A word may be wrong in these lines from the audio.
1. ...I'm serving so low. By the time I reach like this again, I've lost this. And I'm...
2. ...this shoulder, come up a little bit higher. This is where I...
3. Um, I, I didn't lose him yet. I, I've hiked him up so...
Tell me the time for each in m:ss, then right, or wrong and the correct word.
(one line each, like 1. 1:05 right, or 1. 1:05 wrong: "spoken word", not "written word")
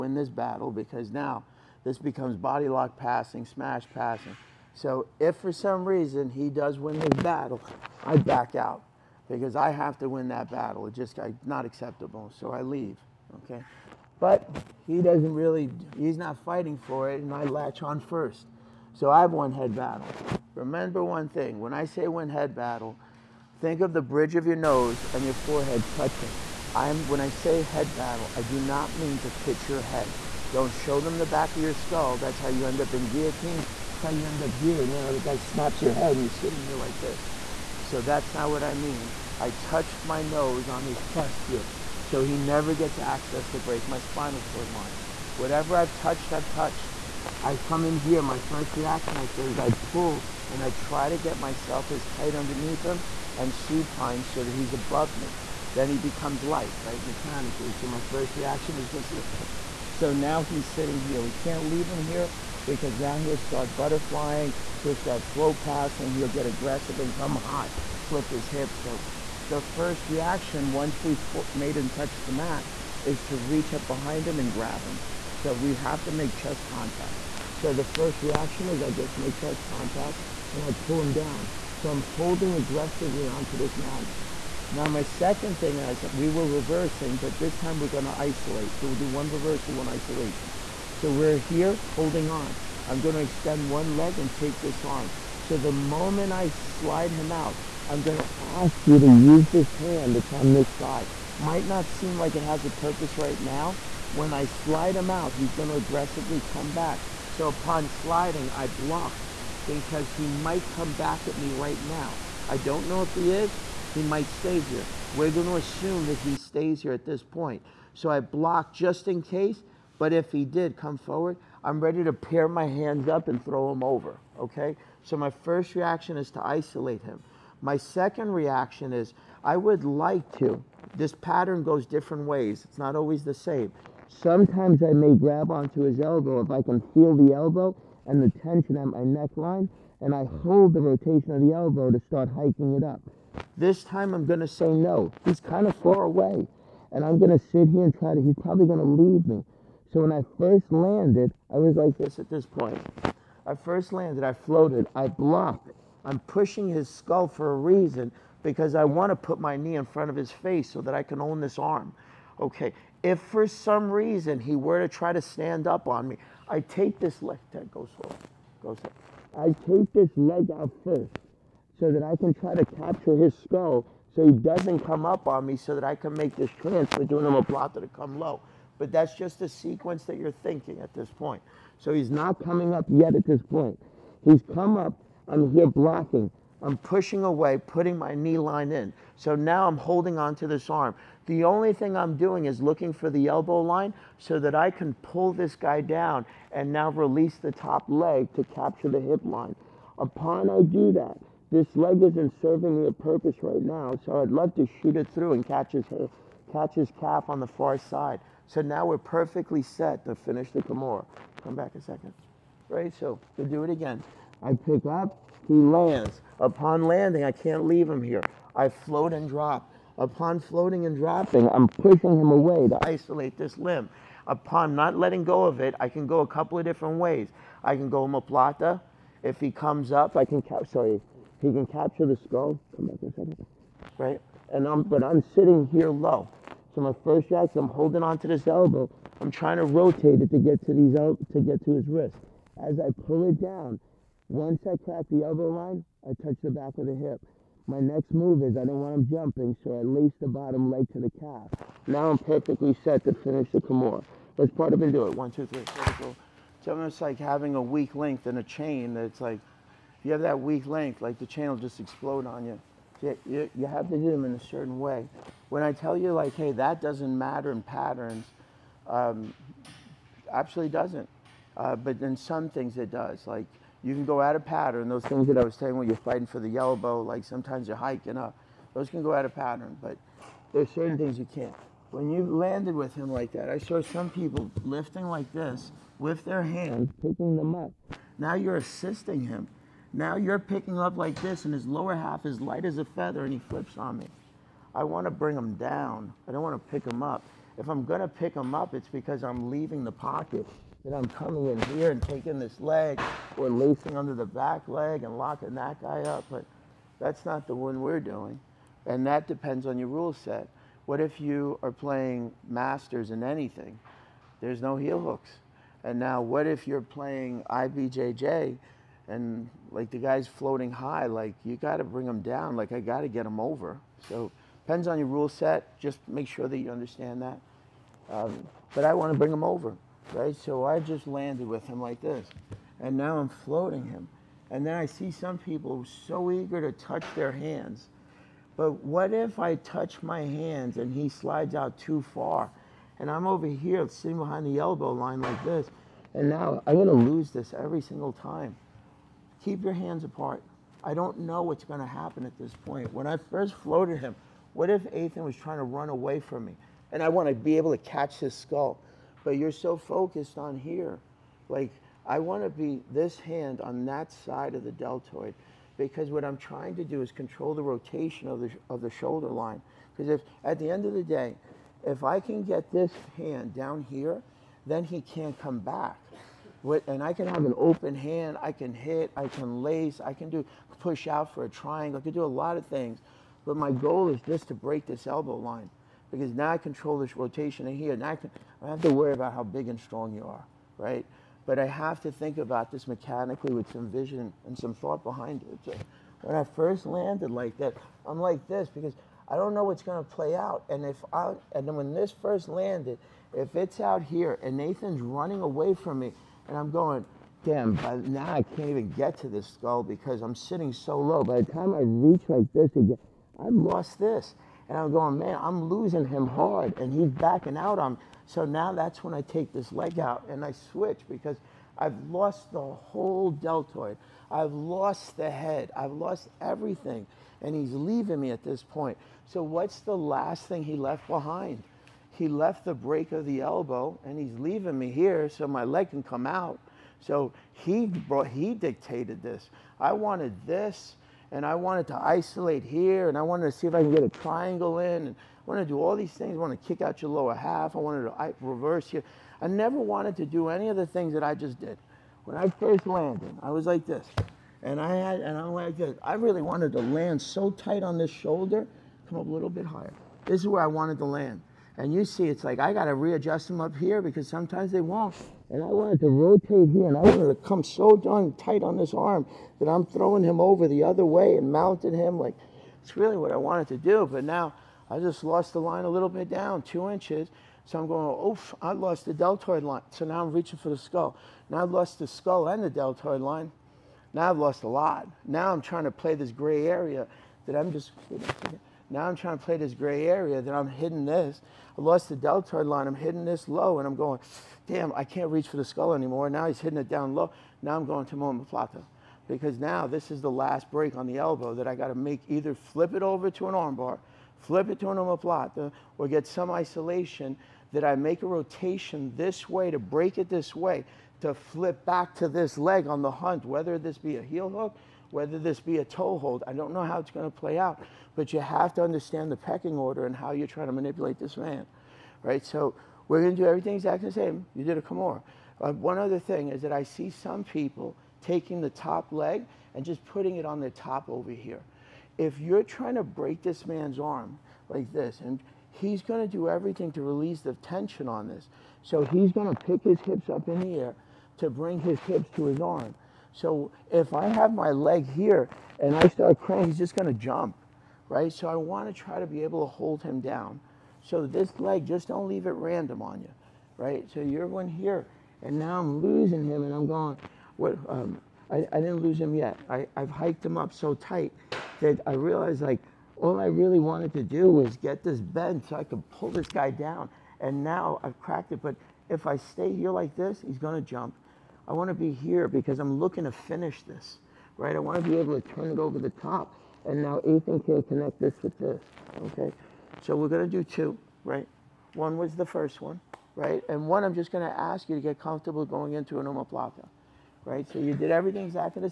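1. 6:50 wrong: "sitting", not "serving"
2. 7:37 right
3. 9:17 right.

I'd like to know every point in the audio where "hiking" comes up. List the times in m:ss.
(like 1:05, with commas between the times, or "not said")
2:22, 4:37.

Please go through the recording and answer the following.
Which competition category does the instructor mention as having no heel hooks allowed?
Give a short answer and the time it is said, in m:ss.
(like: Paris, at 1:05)
masters, at 5:12.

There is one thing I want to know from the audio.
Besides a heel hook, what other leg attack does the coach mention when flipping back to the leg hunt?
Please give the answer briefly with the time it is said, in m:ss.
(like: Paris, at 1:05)
toehold, at 8:35.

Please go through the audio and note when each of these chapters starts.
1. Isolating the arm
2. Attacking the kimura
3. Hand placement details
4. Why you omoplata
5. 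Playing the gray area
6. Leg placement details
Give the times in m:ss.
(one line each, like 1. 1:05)
1. 0:46
2. 3:02
3. 5:33
4. 6:46
5. 8:05
6. 8:46.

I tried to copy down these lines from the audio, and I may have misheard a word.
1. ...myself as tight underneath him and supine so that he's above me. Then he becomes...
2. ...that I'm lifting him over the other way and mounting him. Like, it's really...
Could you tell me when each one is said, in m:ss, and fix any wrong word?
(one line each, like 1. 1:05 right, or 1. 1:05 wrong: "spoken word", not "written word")
1. 0:51 right
2. 7:49 wrong: "throwing", not "lifting".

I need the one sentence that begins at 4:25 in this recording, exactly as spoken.
When I tell you like, hey, that doesn't matter in patterns, um, absolutely doesn't.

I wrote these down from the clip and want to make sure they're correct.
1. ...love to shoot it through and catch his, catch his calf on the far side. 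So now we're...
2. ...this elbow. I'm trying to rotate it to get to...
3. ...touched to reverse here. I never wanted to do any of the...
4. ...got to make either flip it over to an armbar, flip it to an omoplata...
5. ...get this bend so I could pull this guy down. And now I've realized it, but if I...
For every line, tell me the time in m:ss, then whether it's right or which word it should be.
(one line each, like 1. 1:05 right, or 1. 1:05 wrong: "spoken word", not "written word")
1. 3:24 right
2. 3:58 right
3. 7:27 wrong: "wanted", not "touched"
4. 8:21 right
5. 9:24 wrong: "cracked", not "realized".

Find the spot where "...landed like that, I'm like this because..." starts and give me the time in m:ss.
6:36.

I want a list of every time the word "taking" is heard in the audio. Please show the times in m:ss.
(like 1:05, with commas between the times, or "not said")
5:02, 8:48.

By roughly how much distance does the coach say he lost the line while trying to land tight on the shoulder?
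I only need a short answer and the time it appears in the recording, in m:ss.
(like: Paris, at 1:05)
2 inches, at 7:56.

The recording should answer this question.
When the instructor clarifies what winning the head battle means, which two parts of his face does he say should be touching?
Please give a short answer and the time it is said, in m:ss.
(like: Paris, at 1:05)
bridge of your nose and your forehead, at 0:24.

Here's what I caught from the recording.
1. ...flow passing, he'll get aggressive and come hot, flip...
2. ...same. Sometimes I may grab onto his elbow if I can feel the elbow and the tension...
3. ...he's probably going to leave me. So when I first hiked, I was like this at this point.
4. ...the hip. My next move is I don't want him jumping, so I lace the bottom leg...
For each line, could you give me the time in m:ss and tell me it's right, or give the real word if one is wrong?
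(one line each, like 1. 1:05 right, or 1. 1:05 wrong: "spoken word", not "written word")
1. 1:05 right
2. 2:13 right
3. 2:28 wrong: "landed", not "hiked"
4. 4:06 right.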